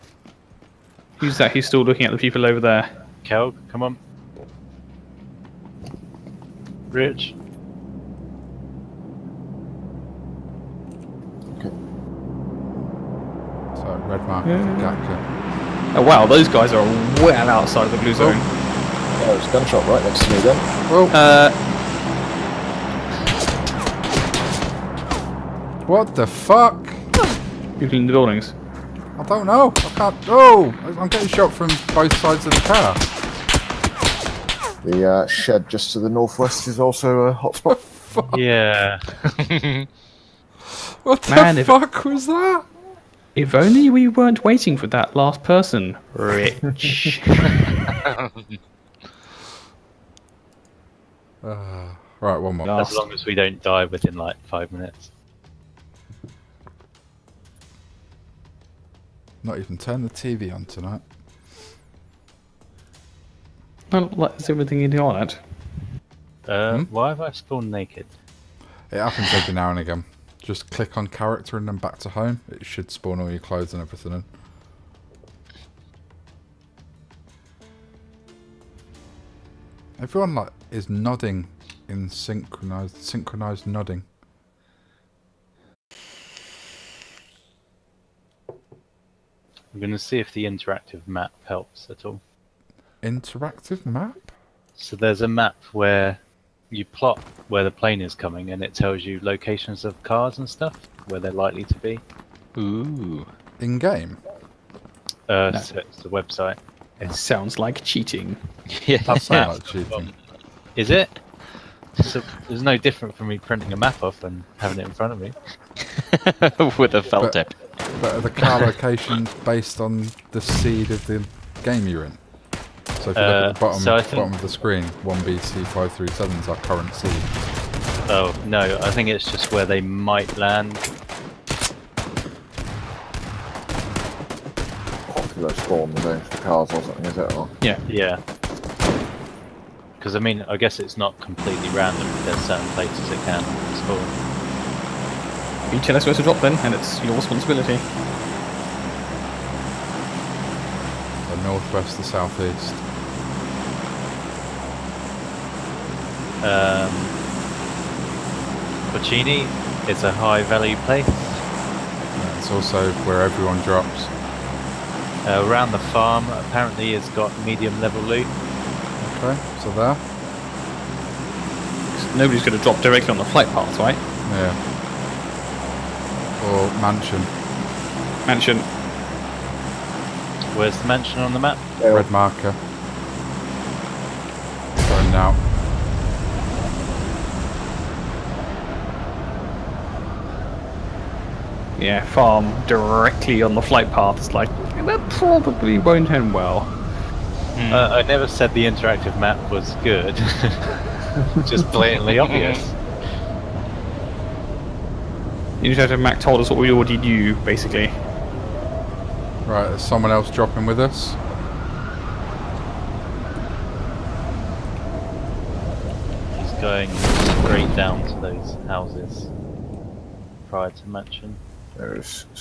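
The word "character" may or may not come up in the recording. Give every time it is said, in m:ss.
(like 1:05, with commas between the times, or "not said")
1:11.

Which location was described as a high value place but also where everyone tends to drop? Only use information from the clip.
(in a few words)
Puccini.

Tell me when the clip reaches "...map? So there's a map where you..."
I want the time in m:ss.
1:33.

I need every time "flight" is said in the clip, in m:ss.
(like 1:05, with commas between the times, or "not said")
2:53, 3:13.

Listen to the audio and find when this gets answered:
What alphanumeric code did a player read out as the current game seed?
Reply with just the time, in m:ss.
2:04.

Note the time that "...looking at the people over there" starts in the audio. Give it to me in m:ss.
0:01.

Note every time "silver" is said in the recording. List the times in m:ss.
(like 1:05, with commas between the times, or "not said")
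not said.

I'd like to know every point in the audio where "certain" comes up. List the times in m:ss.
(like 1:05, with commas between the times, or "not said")
2:22.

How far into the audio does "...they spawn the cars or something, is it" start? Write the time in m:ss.
2:15.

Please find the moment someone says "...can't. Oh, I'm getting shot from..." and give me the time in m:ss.
0:29.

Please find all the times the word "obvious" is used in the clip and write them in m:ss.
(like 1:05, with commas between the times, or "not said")
3:22.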